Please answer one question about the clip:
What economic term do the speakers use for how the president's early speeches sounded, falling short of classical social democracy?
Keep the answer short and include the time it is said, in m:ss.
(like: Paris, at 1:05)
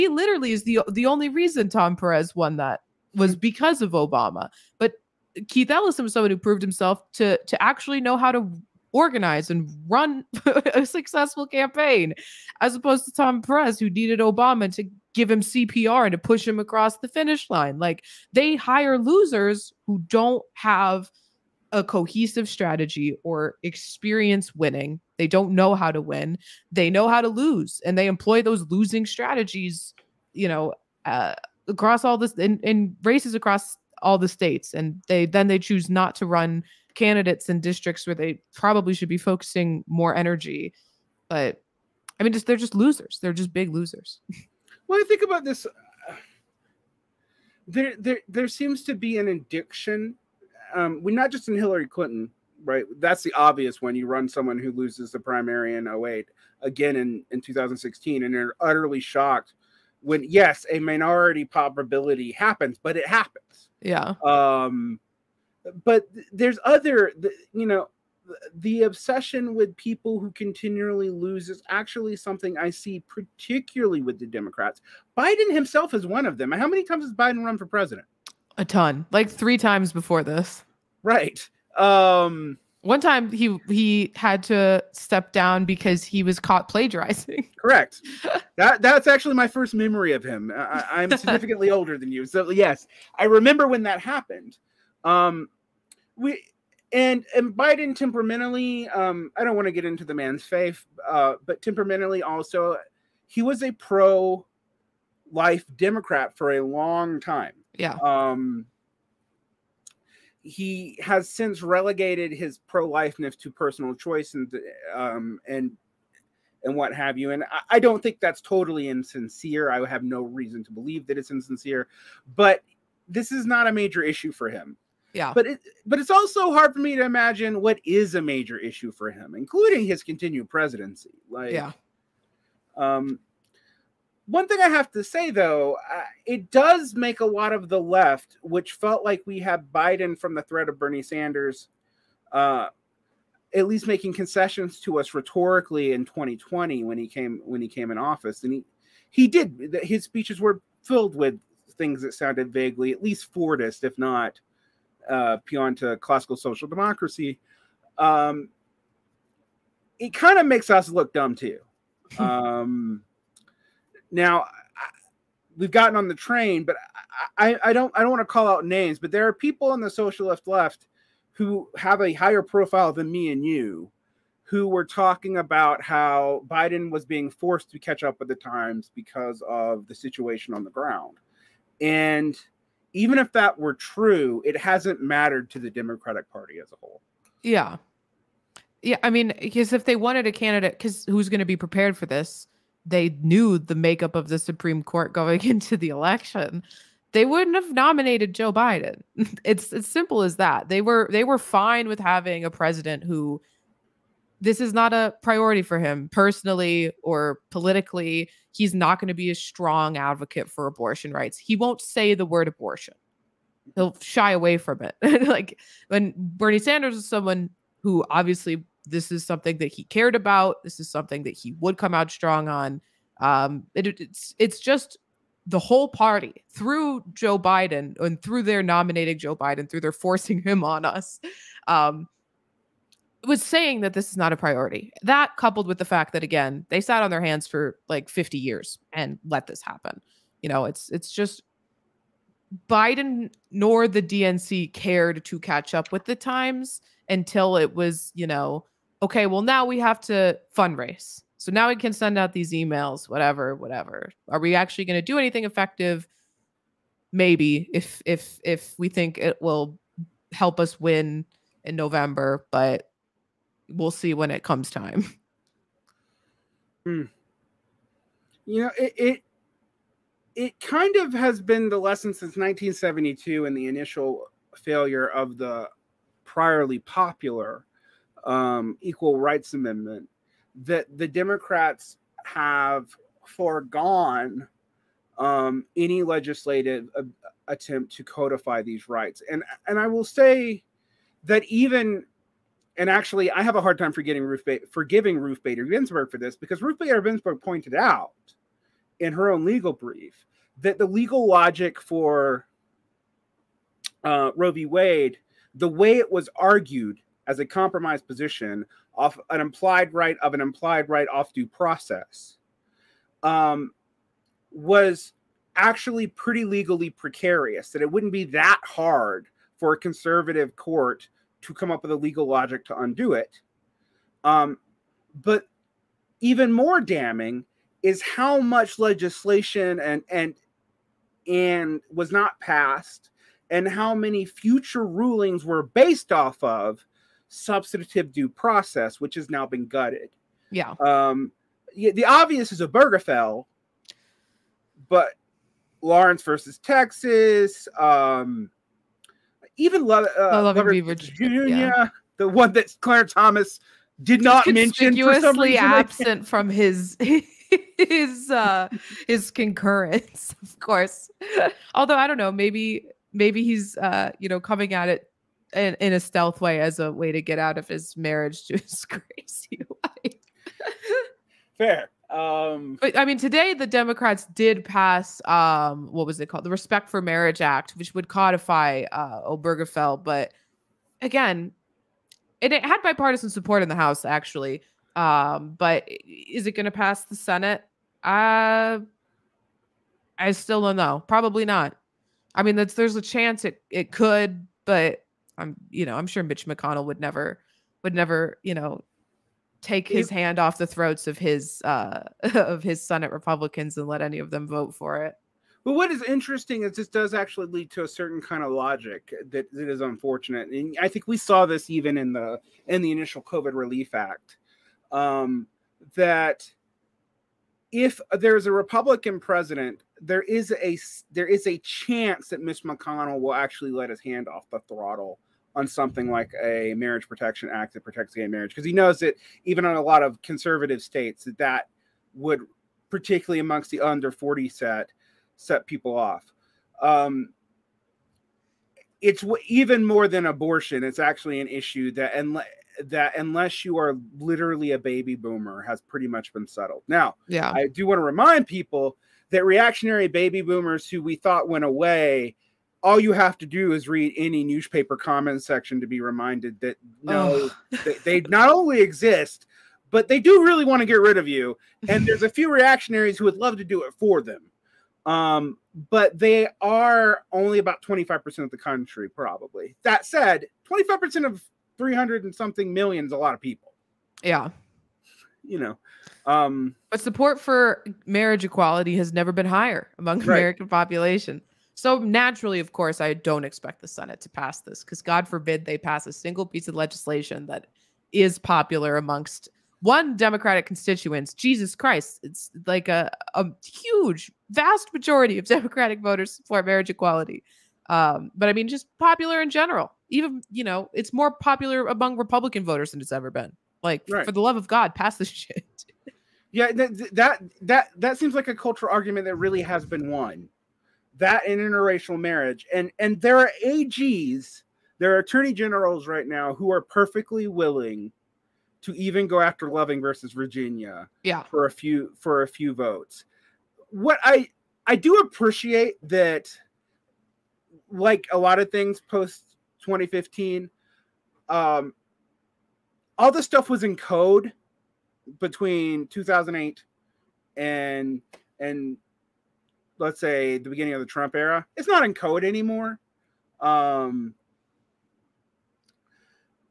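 Fordist, at 2:33.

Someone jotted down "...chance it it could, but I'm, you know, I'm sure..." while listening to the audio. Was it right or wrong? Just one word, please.
right.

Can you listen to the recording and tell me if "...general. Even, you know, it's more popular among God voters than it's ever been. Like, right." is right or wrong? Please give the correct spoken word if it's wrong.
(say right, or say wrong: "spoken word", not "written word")
wrong: "Republican", not "God".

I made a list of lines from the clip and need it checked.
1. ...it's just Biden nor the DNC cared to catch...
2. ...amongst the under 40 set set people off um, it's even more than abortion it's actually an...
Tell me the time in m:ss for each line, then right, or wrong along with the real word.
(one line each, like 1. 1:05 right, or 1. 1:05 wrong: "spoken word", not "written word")
1. 4:00 right
2. 7:13 right.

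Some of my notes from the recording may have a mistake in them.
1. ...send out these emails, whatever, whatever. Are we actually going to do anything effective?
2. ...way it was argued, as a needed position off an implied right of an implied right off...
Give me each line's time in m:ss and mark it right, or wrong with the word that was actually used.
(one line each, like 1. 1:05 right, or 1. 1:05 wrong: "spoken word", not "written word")
1. 4:11 right
2. 5:05 wrong: "compromised", not "needed".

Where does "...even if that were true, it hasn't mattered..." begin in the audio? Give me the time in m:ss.
3:02.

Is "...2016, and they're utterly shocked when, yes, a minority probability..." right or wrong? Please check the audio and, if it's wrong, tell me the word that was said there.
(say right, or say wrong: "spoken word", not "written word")
right.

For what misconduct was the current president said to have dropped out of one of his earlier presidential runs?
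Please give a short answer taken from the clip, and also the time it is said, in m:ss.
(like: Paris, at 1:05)
Plagiarizing, at 1:26.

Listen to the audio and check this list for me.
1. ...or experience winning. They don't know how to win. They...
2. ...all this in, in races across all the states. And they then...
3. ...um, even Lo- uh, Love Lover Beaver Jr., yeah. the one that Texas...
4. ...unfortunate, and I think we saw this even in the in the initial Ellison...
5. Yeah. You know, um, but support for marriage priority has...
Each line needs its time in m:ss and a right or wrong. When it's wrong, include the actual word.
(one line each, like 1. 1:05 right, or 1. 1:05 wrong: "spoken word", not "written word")
1. 0:23 right
2. 0:32 right
3. 5:47 wrong: "Clarence", not "Texas"
4. 6:49 wrong: "COVID", not "Ellison"
5. 7:54 wrong: "equality", not "priority".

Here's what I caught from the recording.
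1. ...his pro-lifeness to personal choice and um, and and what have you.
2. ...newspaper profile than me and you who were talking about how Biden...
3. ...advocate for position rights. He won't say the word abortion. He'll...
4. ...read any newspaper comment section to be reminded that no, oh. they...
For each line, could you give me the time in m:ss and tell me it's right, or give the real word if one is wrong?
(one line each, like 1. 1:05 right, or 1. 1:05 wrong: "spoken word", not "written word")
1. 1:52 right
2. 2:52 wrong: "higher", not "newspaper"
3. 3:29 wrong: "abortion", not "position"
4. 7:33 right.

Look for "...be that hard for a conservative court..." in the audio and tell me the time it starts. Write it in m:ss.
5:18.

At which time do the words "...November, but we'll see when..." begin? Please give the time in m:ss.
4:21.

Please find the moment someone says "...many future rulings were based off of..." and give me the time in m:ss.
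5:33.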